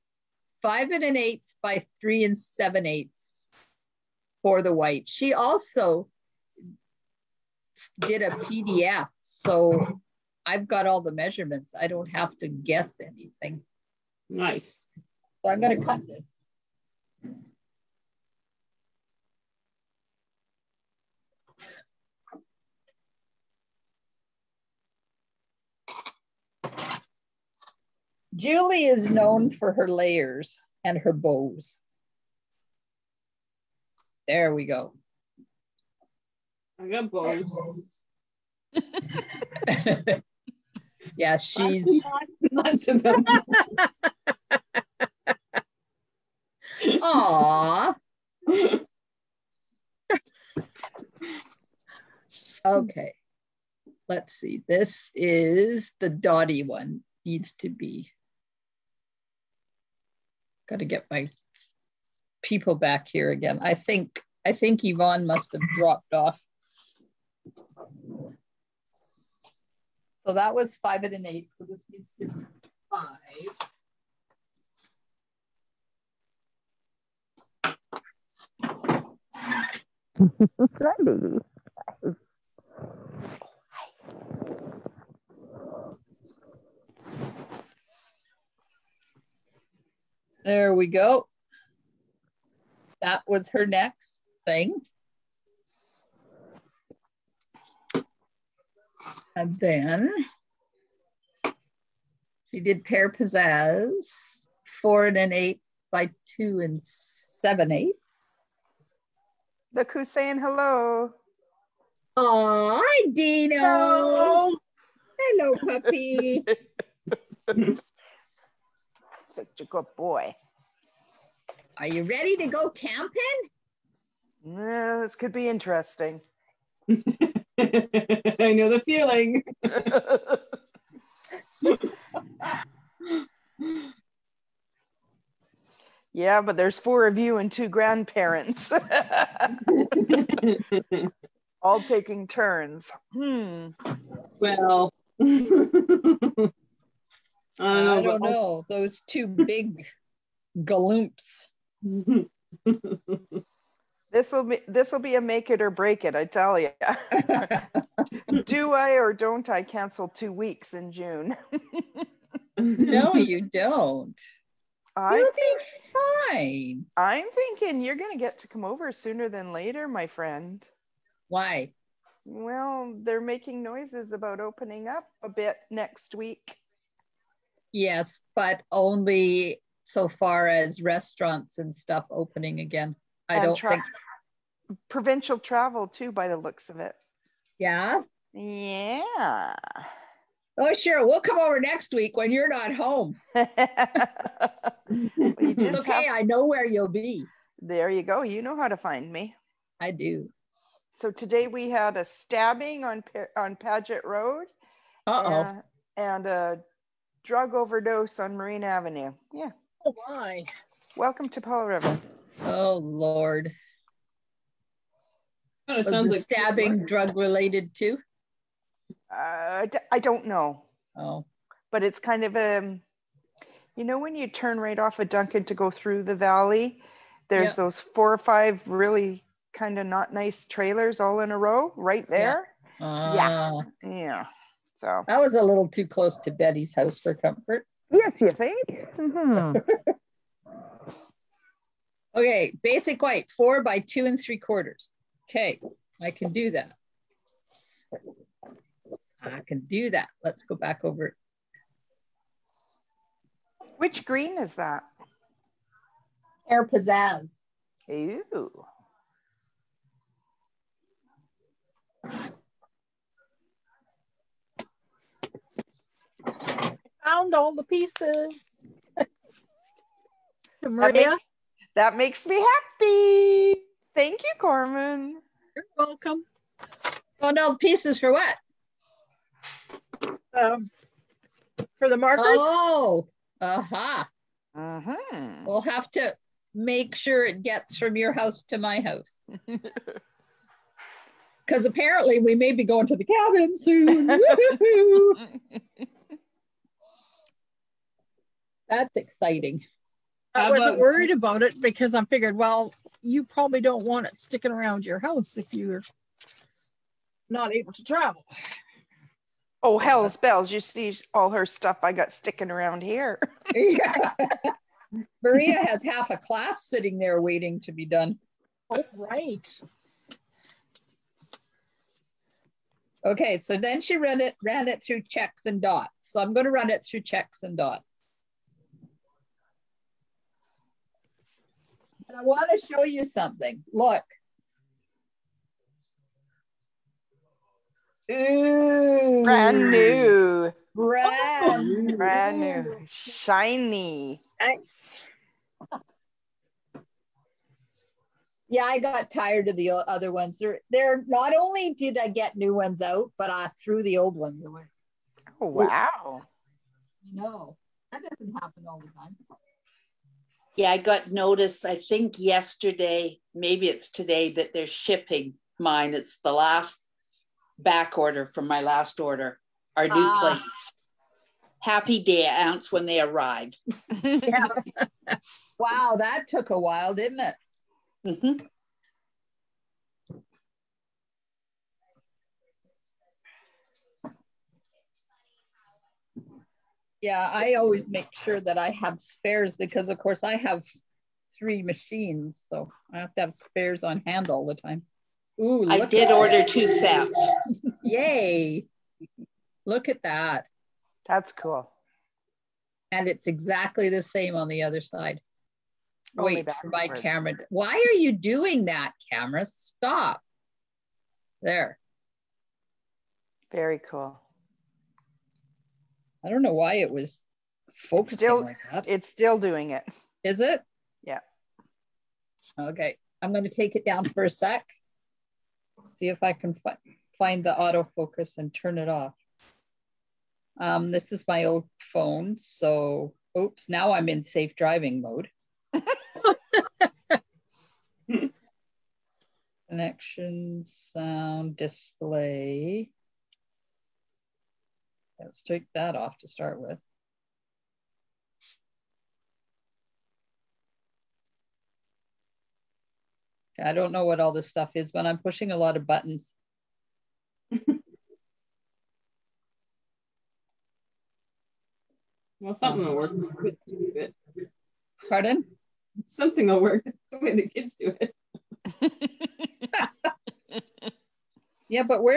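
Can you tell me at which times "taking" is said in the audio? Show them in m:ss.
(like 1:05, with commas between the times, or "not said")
2:21.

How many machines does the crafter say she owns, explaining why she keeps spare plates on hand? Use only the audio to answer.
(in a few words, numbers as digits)
3.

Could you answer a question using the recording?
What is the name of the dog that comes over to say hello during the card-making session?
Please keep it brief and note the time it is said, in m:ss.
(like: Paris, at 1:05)
Dino, at 1:53.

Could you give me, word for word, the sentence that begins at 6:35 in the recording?
Ooh, I did order two sets.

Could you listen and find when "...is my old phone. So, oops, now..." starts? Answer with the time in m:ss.
7:11.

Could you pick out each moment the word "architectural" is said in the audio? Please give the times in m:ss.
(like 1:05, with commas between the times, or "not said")
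not said.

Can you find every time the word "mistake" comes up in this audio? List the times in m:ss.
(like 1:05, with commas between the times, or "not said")
not said.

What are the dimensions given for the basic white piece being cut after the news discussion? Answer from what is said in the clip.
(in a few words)
4 by 2 3/4.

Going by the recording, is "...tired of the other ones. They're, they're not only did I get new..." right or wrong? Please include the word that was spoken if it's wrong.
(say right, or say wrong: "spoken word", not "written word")
right.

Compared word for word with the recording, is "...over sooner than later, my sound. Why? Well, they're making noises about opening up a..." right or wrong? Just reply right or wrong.
wrong.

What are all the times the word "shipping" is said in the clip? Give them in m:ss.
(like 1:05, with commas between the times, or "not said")
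6:04.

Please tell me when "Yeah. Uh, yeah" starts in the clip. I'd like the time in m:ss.
3:52.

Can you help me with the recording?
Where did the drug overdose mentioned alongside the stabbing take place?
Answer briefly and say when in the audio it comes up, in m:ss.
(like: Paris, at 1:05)
Marine Avenue, at 3:28.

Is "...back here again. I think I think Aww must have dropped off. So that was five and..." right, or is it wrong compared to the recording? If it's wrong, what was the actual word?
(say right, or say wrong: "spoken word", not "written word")
wrong: "Yvonne", not "Aww".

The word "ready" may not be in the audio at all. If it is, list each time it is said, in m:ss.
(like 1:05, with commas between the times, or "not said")
2:02.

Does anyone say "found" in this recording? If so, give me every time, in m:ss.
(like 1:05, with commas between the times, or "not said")
4:27, 4:37.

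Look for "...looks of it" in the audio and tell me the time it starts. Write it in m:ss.
3:06.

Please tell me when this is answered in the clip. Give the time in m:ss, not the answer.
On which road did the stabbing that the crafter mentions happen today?
3:23.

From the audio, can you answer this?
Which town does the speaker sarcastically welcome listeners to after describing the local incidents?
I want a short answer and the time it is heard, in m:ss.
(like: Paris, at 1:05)
Powell River, at 3:31.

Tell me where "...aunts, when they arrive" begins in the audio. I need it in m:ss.
6:12.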